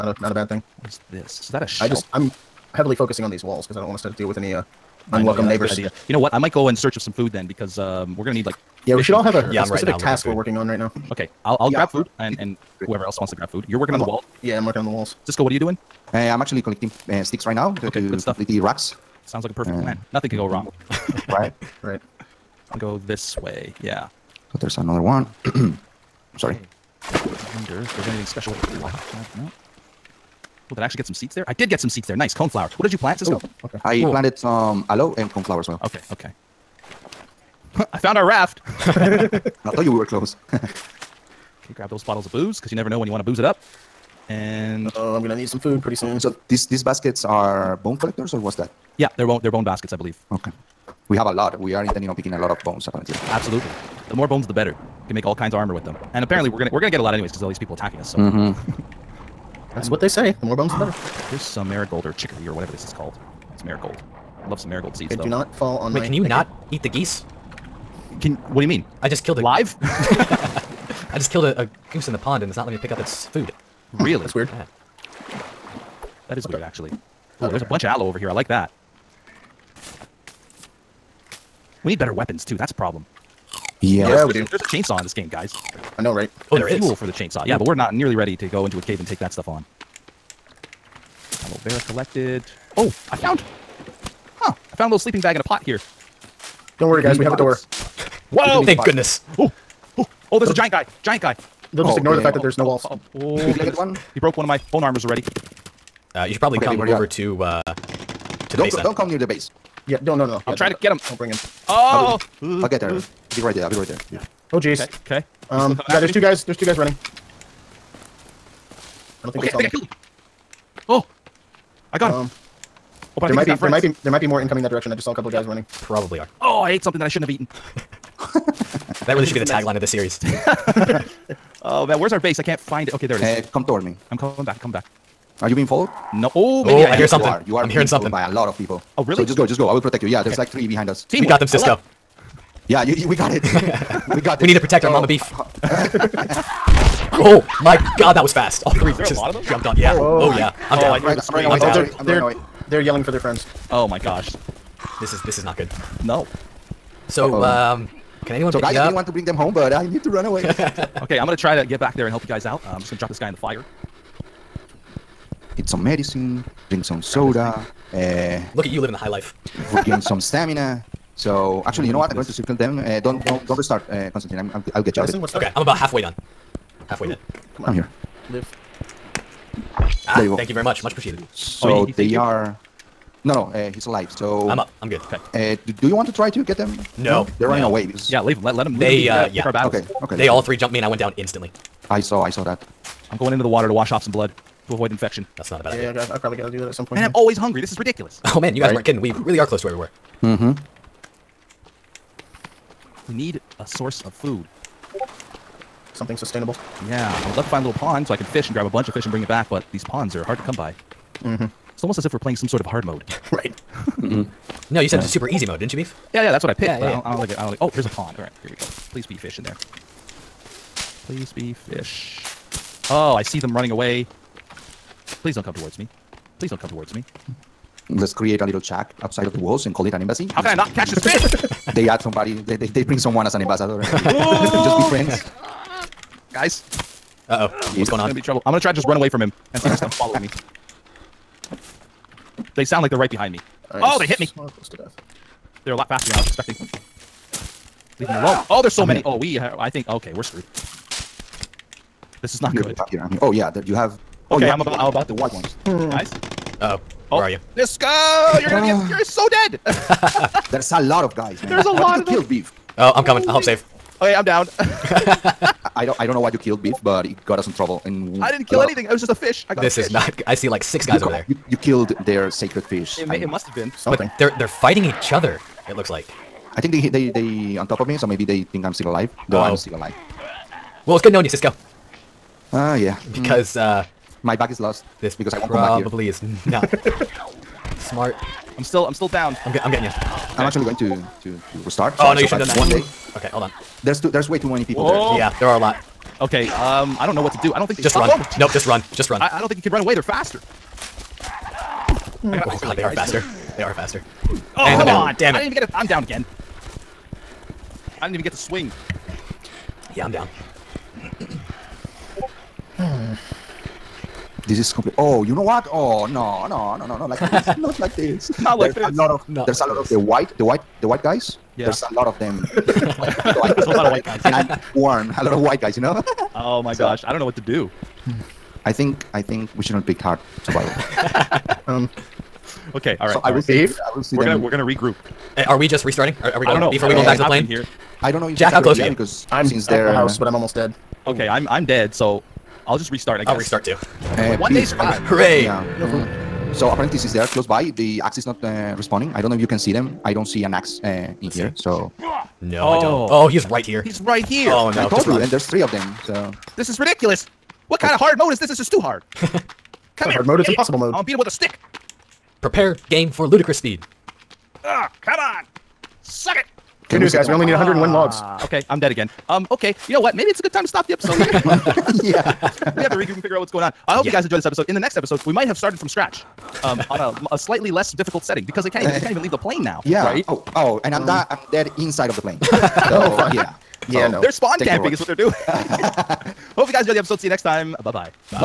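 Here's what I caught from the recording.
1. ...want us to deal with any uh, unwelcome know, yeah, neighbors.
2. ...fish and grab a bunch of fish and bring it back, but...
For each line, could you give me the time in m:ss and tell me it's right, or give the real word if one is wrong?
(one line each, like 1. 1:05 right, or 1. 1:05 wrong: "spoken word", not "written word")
1. 0:03 right
2. 3:28 right.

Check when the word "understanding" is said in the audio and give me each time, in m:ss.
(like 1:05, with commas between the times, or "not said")
not said.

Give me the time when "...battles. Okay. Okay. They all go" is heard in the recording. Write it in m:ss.
3:09.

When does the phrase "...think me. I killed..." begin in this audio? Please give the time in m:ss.
1:59.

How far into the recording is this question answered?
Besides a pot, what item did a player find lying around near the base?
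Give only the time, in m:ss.
1:34.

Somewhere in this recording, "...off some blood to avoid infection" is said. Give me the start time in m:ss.
3:13.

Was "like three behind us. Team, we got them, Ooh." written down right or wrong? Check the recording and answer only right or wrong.
wrong.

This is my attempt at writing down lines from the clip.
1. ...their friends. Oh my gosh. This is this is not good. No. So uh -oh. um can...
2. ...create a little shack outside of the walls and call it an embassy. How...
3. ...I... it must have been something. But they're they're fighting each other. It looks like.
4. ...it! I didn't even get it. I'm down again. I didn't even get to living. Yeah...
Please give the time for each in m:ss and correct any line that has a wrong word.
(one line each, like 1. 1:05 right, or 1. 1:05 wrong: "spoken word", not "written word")
1. 2:33 right
2. 3:48 right
3. 4:33 right
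4. 5:05 wrong: "swing", not "living".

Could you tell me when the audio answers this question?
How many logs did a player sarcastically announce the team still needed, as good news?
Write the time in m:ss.
6:07.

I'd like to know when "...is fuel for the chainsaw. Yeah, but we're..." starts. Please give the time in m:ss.
1:26.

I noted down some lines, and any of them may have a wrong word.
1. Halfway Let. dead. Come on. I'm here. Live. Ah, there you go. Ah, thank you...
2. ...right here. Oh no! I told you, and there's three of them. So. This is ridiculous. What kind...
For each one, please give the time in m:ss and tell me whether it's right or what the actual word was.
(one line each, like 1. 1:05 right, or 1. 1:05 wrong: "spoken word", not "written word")
1. 2:56 wrong: "Ooh", not "Let"
2. 5:54 right.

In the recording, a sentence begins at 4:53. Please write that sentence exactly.
There's too, there's way too many people Whoa.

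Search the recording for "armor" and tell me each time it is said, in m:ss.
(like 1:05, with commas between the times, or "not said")
0:55, 1:44.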